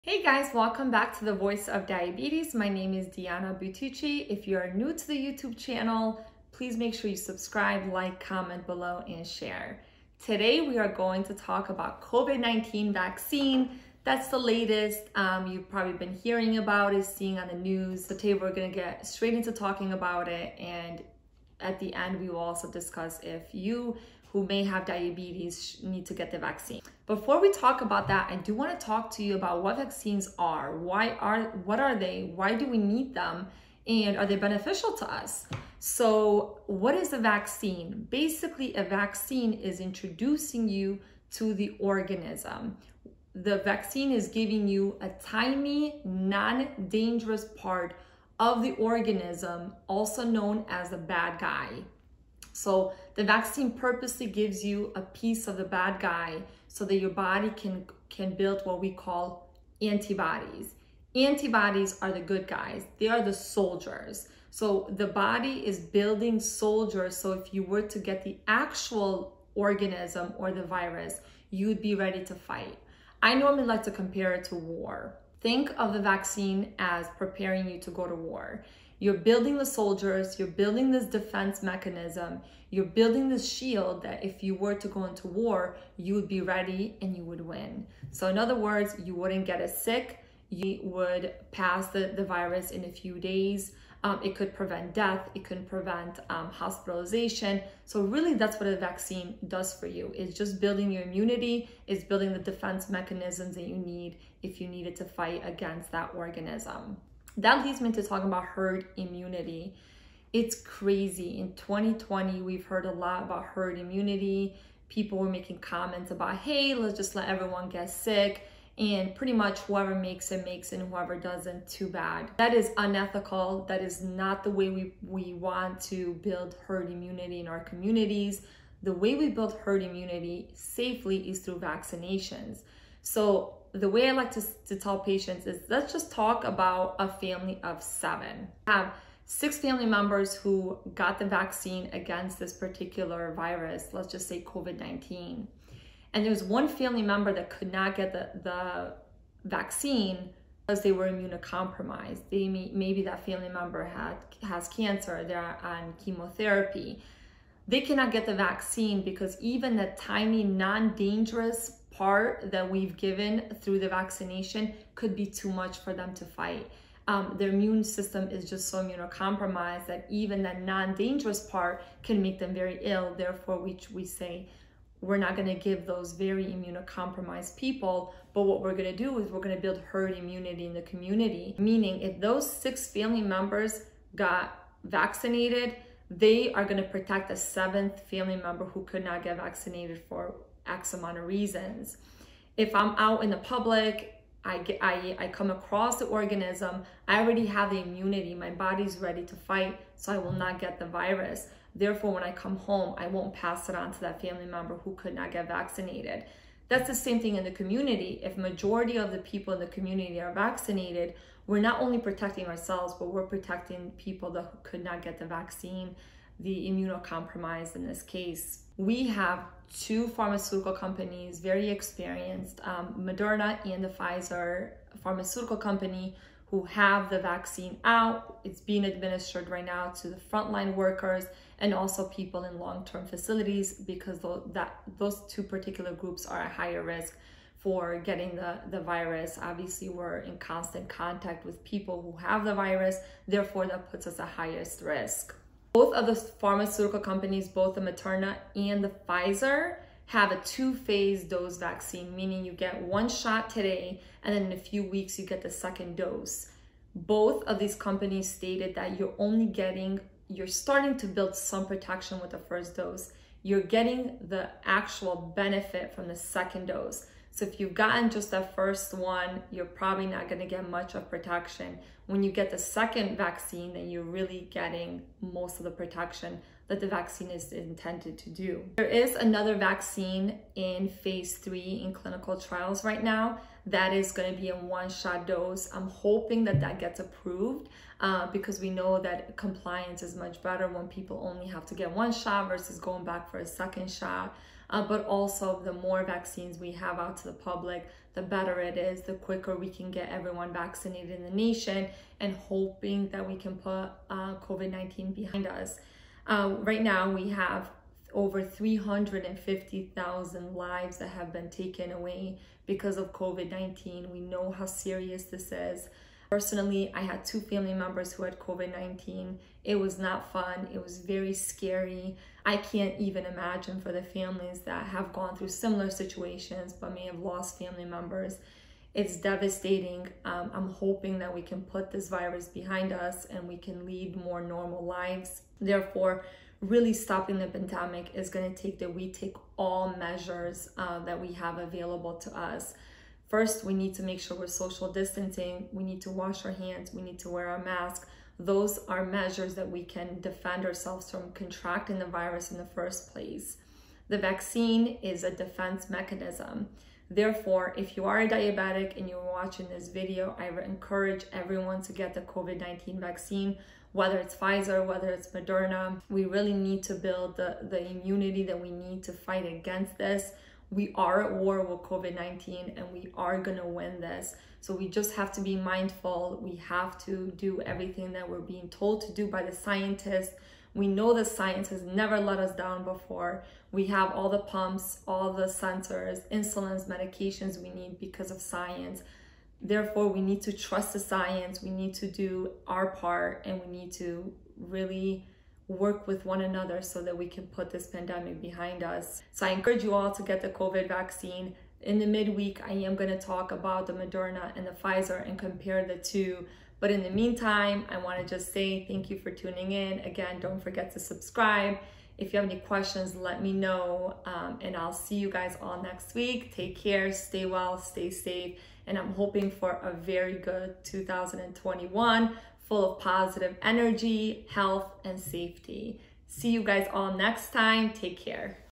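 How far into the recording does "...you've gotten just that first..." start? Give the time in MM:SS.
04:27.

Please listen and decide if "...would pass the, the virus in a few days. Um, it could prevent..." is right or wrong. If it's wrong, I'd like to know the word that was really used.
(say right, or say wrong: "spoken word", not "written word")
right.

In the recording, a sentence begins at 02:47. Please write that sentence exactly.
Um, their immune system is just so immunocompromised that even that non-dangerous part can make them very ill.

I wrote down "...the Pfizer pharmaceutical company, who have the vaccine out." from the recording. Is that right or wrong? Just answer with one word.
right.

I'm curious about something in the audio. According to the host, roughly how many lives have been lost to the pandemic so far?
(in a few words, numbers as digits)
over 350,000.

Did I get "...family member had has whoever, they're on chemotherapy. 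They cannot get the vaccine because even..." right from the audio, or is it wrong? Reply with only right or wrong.
wrong.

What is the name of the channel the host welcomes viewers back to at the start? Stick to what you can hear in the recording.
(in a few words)
Voice of Diabetes.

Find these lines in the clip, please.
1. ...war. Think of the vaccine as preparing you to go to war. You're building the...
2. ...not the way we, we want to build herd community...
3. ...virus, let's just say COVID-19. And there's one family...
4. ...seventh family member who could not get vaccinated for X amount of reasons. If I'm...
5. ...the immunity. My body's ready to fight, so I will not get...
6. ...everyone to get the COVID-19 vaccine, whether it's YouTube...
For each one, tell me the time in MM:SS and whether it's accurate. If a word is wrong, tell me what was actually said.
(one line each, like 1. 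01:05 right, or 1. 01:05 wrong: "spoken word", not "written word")
1. 01:14 right
2. 02:04 wrong: "immunity", not "community"
3. 02:23 right
4. 03:07 right
5. 03:17 right
6. 06:01 wrong: "Pfizer", not "YouTube".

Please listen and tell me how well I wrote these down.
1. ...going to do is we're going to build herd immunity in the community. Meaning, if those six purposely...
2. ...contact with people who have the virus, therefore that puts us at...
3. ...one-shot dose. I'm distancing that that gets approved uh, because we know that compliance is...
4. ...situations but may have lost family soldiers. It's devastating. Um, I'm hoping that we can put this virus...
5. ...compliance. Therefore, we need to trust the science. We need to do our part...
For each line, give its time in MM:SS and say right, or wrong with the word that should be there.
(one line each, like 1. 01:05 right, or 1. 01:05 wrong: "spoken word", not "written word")
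1. 02:58 wrong: "family", not "purposely"
2. 04:00 right
3. 04:44 wrong: "hoping", not "distancing"
4. 05:25 wrong: "members", not "soldiers"
5. 06:28 wrong: "science", not "compliance".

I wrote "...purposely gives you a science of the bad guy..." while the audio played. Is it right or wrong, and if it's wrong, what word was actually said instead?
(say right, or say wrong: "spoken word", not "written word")
wrong: "piece", not "science".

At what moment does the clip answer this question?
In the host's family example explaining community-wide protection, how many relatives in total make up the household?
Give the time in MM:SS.
02:17.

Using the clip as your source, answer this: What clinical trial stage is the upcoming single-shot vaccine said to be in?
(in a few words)
phase three.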